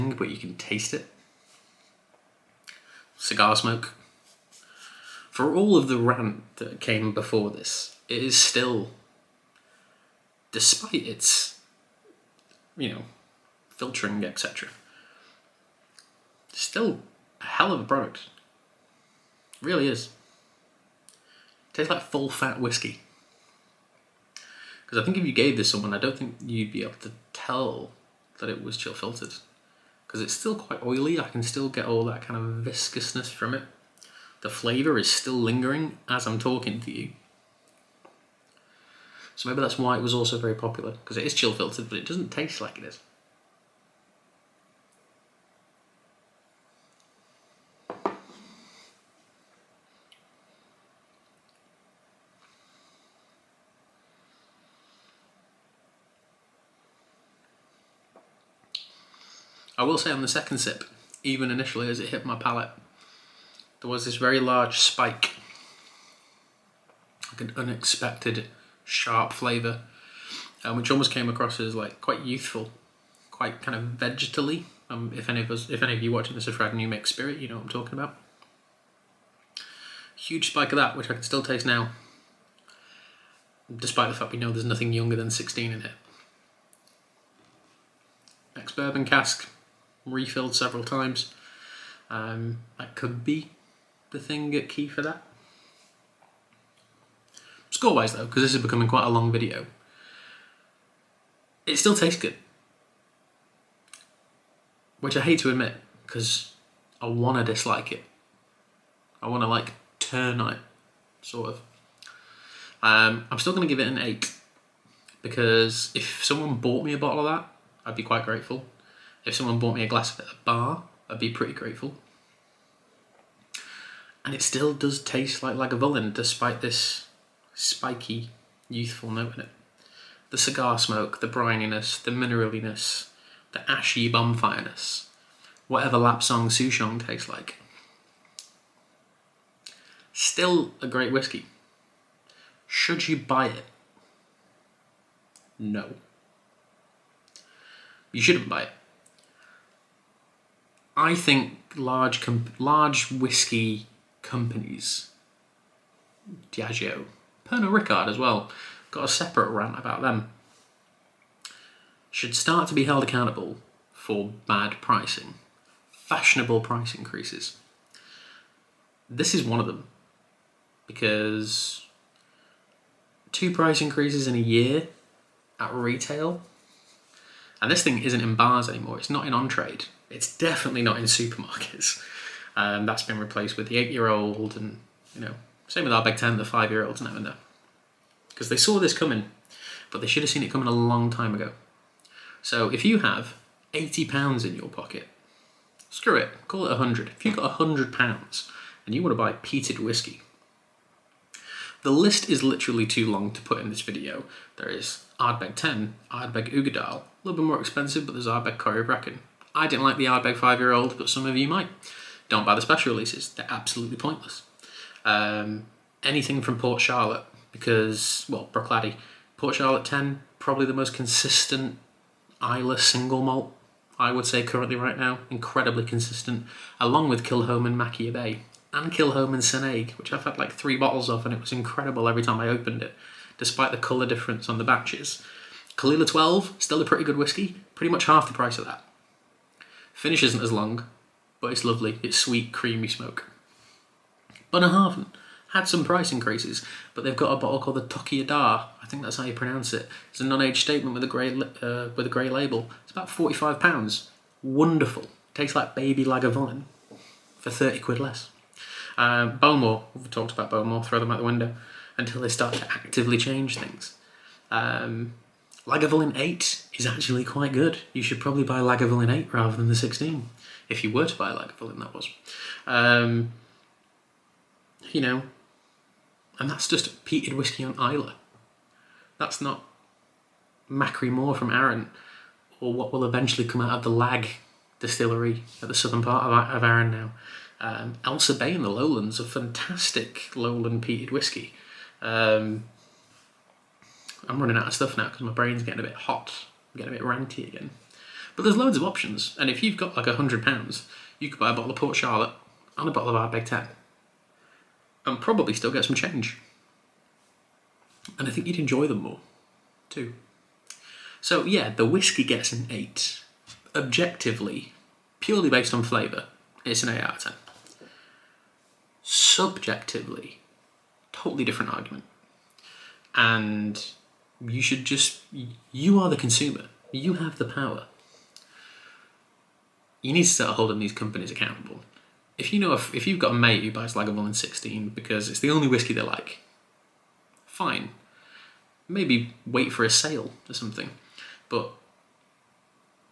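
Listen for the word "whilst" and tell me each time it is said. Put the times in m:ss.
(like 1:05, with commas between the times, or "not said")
not said.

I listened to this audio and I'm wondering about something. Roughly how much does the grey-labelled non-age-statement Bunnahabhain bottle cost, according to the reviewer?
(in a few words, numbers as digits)
£45.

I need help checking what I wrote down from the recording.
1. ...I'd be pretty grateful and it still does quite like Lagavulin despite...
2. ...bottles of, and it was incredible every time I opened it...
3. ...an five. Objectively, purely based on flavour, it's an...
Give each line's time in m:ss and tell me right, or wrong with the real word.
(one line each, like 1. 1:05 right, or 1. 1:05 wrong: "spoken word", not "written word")
1. 2:01 wrong: "taste", not "quite"
2. 3:50 right
3. 5:12 wrong: "eight", not "five".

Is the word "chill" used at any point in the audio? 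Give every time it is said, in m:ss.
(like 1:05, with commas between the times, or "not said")
0:28, 0:41.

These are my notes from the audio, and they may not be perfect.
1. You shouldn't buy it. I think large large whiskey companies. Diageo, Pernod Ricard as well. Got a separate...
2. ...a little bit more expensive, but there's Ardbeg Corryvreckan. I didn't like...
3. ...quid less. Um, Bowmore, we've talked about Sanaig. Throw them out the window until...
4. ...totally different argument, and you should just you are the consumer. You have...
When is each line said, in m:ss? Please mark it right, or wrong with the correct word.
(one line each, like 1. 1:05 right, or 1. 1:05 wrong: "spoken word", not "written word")
1. 2:28 right
2. 3:27 right
3. 4:17 wrong: "Bowmore", not "Sanaig"
4. 5:21 right.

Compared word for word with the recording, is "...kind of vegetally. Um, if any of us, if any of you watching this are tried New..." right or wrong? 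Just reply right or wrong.
right.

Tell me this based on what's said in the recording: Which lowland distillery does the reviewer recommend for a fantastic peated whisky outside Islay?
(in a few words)
Ailsa Bay.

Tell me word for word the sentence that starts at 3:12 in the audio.
So if you have eighty pounds in your pocket, screw it, call it a hundred.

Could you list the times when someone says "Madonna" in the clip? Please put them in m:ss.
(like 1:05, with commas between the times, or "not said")
not said.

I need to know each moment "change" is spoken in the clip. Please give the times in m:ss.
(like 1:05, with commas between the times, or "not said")
4:23, 5:05.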